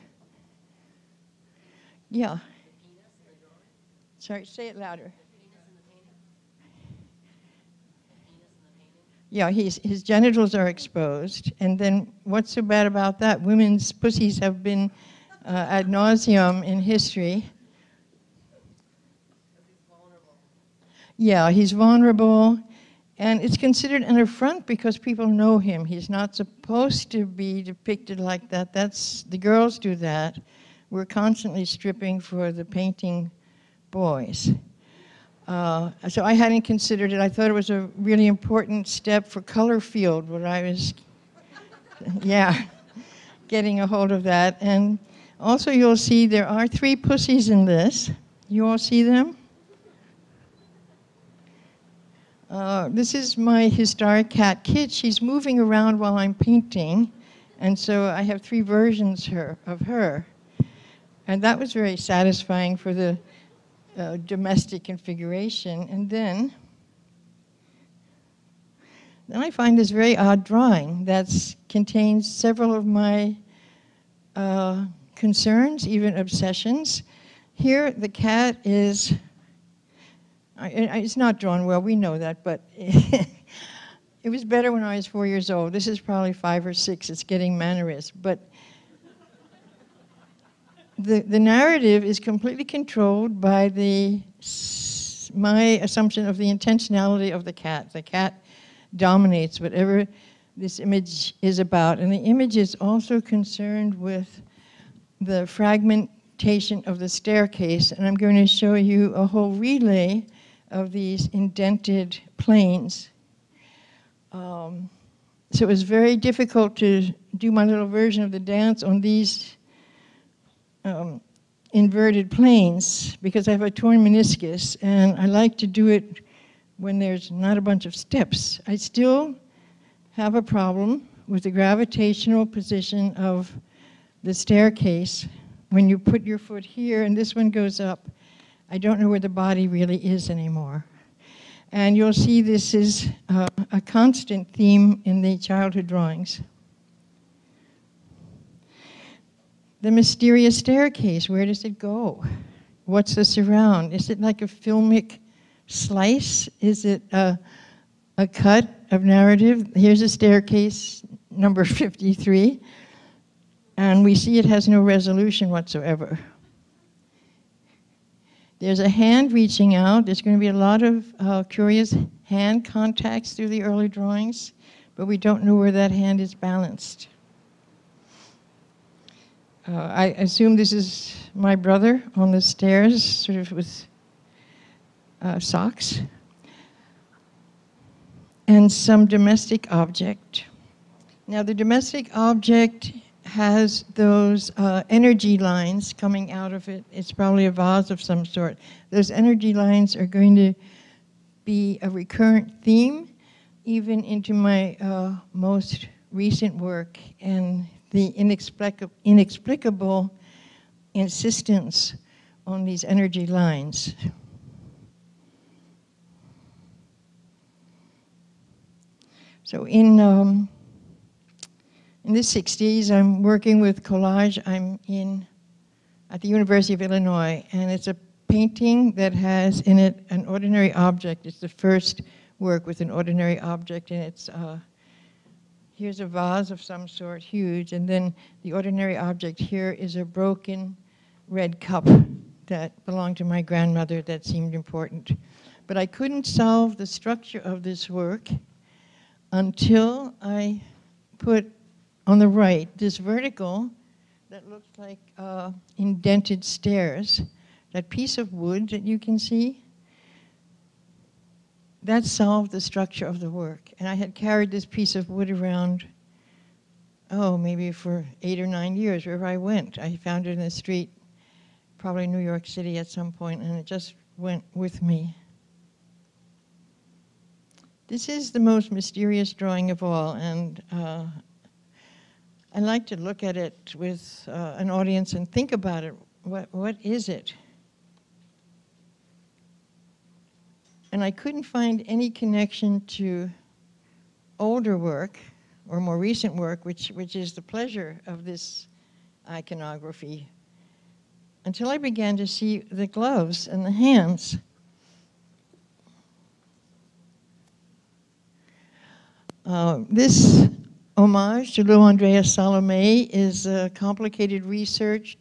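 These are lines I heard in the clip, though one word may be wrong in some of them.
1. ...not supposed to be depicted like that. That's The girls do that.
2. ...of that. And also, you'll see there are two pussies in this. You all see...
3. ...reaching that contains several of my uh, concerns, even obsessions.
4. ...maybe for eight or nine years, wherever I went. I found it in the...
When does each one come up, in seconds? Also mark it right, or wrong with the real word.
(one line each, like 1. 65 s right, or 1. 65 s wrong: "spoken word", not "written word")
1. 26 s right
2. 44 s wrong: "three", not "two"
3. 70 s wrong: "drawing", not "reaching"
4. 267 s right.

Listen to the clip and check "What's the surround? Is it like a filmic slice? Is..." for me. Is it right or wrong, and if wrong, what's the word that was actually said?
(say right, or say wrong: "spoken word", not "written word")
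right.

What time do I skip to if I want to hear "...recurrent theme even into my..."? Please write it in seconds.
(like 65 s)
201 s.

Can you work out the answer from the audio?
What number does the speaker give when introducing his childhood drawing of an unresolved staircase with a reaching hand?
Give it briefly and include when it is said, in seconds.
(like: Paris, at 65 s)
53, at 161 s.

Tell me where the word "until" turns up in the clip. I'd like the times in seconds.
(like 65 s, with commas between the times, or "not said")
249 s, 301 s.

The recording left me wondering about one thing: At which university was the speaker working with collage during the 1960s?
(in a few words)
University of Illinois.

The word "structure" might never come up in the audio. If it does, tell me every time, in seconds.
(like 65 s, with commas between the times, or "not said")
246 s, 262 s.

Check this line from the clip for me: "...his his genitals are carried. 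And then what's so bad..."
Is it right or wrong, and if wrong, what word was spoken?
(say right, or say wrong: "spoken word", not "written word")
wrong: "exposed", not "carried".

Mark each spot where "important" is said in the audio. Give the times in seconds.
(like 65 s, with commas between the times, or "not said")
38 s, 244 s.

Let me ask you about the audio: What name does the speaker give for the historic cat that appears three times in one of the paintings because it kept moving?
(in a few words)
Kit.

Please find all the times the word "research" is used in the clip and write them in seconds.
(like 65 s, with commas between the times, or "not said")
314 s.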